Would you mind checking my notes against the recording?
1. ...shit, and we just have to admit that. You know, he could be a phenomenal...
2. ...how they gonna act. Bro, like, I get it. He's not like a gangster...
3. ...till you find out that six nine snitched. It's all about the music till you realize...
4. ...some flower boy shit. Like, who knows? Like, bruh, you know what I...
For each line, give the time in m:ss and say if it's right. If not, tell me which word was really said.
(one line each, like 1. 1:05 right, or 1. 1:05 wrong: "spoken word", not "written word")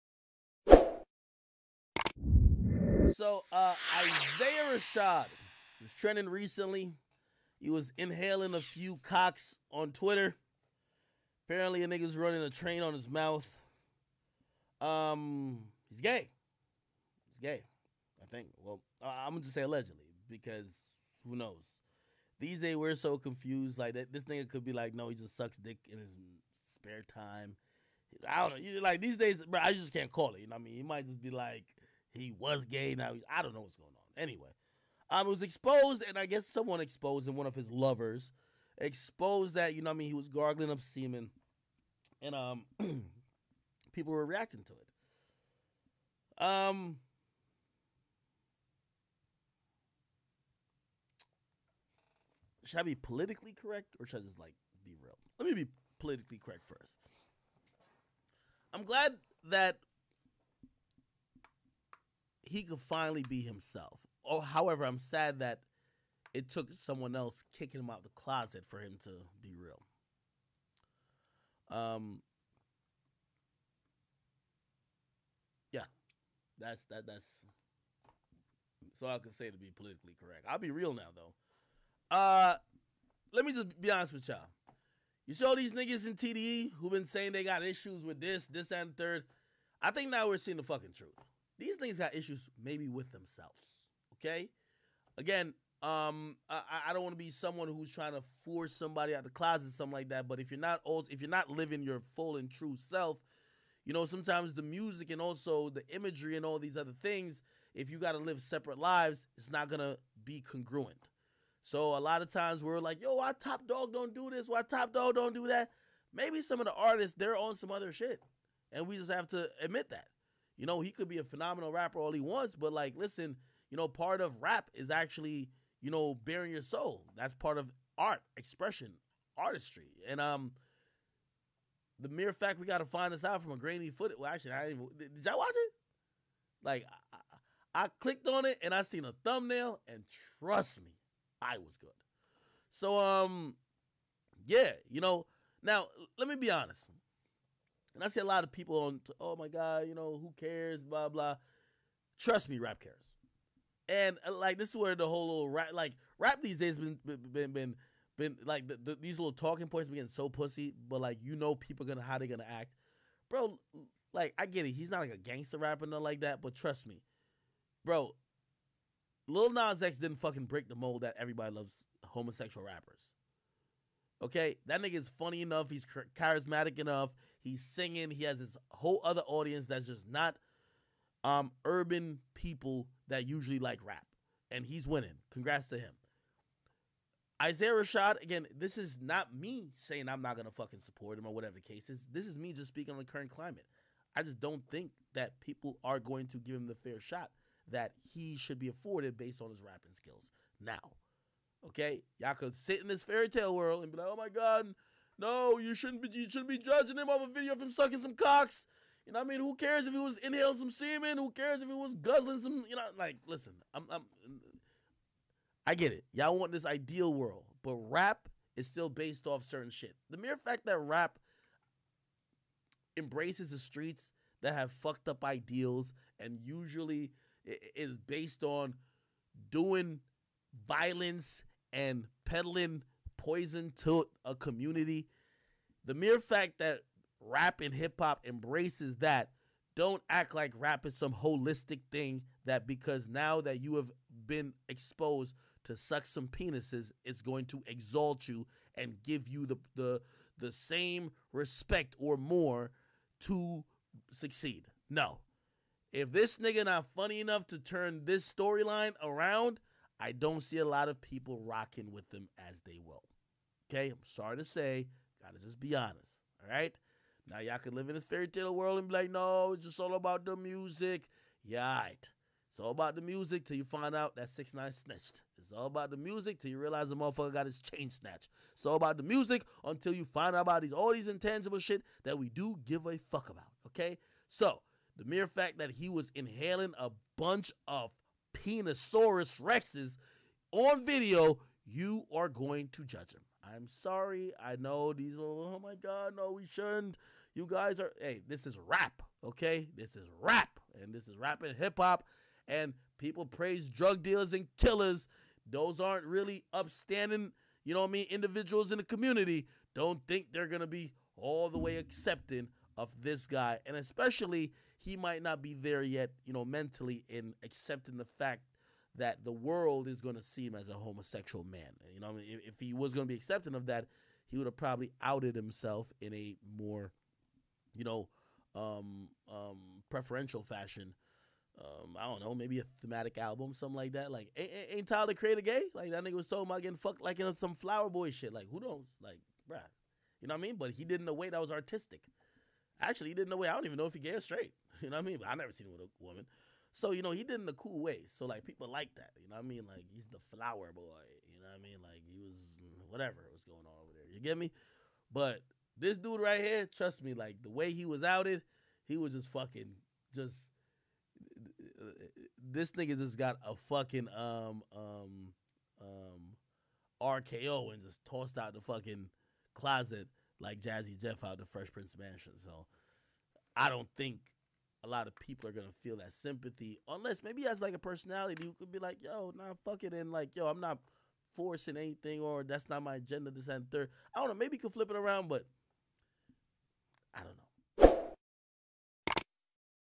1. 1:57 right
2. 2:42 right
3. 4:33 right
4. 5:37 right.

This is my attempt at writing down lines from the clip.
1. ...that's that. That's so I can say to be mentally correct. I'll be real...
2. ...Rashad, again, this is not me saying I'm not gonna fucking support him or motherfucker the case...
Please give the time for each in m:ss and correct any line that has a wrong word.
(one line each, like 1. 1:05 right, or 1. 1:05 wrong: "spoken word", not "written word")
1. 1:16 wrong: "politically", not "mentally"
2. 3:07 wrong: "whatever", not "motherfucker".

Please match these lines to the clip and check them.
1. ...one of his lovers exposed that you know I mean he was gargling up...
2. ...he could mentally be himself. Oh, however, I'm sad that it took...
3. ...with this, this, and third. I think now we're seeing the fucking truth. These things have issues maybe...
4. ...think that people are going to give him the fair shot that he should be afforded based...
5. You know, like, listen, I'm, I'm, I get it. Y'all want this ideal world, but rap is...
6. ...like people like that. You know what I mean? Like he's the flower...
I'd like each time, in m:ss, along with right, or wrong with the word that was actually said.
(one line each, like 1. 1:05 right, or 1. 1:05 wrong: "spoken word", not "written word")
1. 0:37 right
2. 1:02 wrong: "finally", not "mentally"
3. 1:28 right
4. 3:14 right
5. 3:32 right
6. 5:48 right.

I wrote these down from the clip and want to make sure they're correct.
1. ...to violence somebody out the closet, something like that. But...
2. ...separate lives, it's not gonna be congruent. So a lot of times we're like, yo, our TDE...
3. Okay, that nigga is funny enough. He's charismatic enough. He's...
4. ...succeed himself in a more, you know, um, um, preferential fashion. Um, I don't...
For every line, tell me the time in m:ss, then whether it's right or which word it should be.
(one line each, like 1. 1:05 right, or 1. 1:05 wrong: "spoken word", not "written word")
1. 1:38 wrong: "force", not "violence"
2. 1:48 wrong: "Top", not "TDE"
3. 2:54 right
4. 5:25 wrong: "outed", not "succeed".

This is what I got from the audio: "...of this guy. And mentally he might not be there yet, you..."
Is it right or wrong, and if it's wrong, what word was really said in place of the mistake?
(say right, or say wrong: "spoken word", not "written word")
wrong: "especially", not "mentally".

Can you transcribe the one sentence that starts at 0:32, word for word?
Now he's, I don't know what's going on.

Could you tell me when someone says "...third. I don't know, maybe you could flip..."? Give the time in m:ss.
6:23.